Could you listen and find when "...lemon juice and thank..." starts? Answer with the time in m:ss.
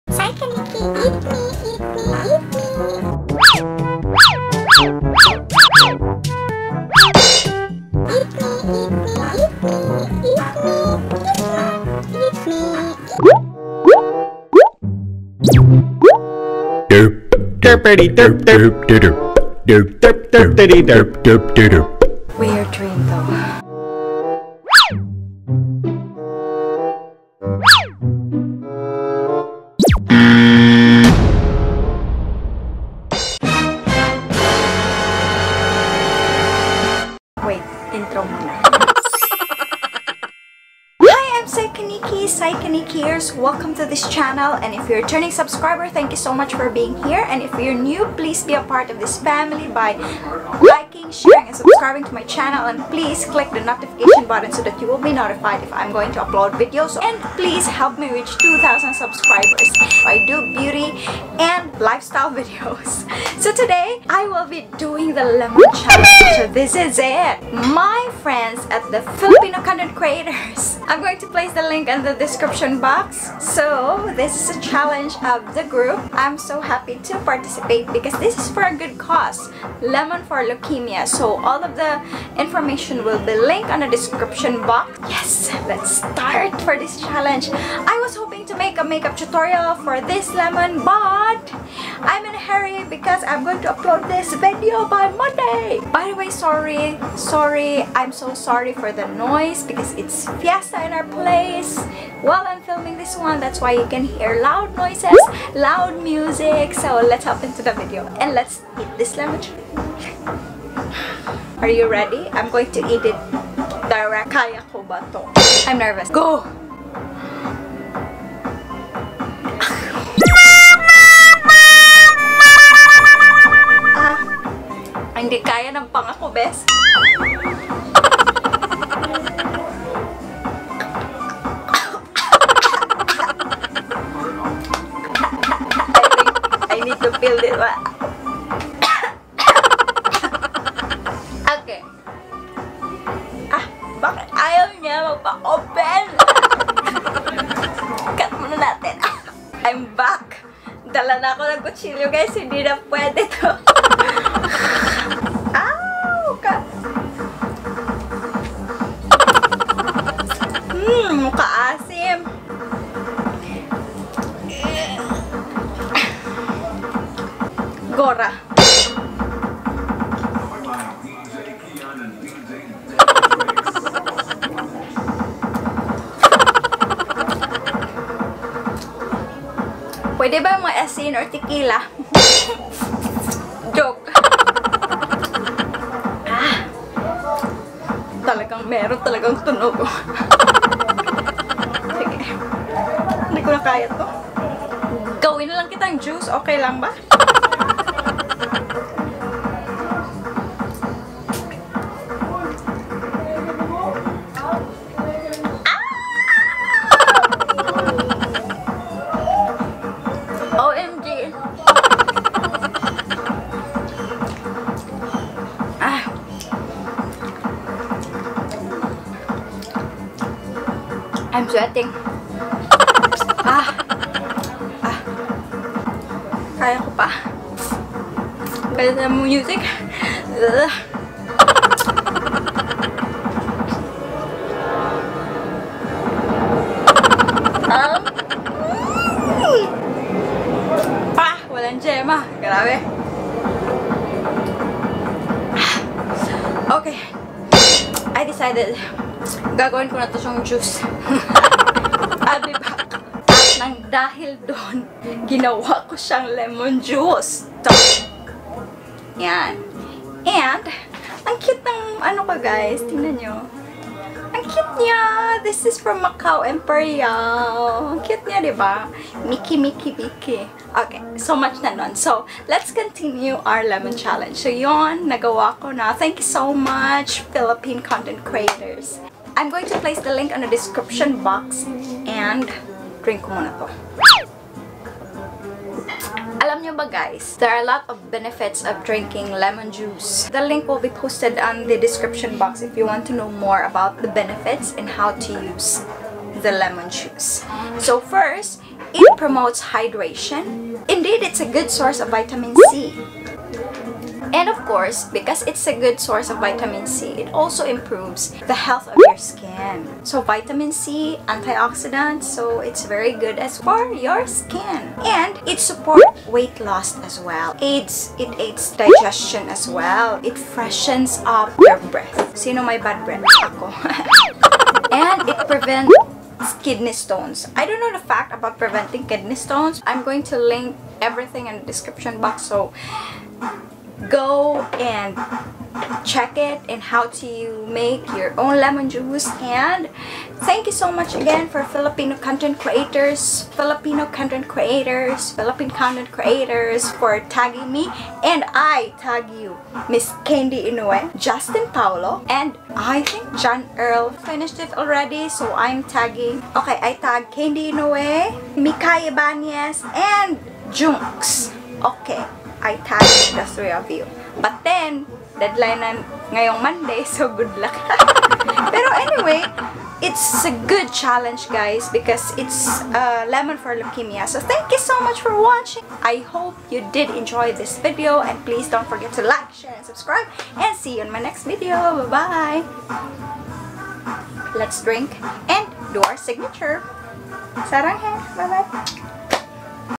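5:38.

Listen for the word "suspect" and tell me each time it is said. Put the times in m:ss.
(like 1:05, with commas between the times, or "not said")
not said.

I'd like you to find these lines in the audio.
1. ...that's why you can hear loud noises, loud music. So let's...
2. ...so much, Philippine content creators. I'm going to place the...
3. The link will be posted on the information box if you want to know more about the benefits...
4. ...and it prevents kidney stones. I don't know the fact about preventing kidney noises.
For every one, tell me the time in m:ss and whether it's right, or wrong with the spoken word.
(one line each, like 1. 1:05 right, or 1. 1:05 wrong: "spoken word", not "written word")
1. 1:43 right
2. 4:36 right
3. 4:50 wrong: "description", not "information"
4. 5:24 wrong: "stones", not "noises".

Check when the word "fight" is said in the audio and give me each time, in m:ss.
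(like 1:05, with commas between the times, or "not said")
not said.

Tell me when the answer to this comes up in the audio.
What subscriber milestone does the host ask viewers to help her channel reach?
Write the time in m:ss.
0:58.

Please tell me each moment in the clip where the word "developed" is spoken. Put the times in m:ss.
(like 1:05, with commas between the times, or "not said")
not said.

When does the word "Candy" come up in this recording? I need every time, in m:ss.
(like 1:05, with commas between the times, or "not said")
5:50, 5:57.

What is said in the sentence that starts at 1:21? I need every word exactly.
So all of the information will be linked on the description box.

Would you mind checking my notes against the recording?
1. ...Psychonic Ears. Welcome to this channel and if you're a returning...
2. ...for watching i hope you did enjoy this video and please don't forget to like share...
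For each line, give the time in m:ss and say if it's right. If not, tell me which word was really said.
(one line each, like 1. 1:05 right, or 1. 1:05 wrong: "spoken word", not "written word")
1. 0:42 right
2. 6:15 right.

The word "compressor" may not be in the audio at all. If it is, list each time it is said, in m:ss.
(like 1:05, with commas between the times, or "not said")
not said.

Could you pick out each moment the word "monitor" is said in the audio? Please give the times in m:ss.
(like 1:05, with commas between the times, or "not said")
not said.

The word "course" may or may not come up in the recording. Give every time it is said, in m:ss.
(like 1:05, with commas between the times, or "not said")
5:04.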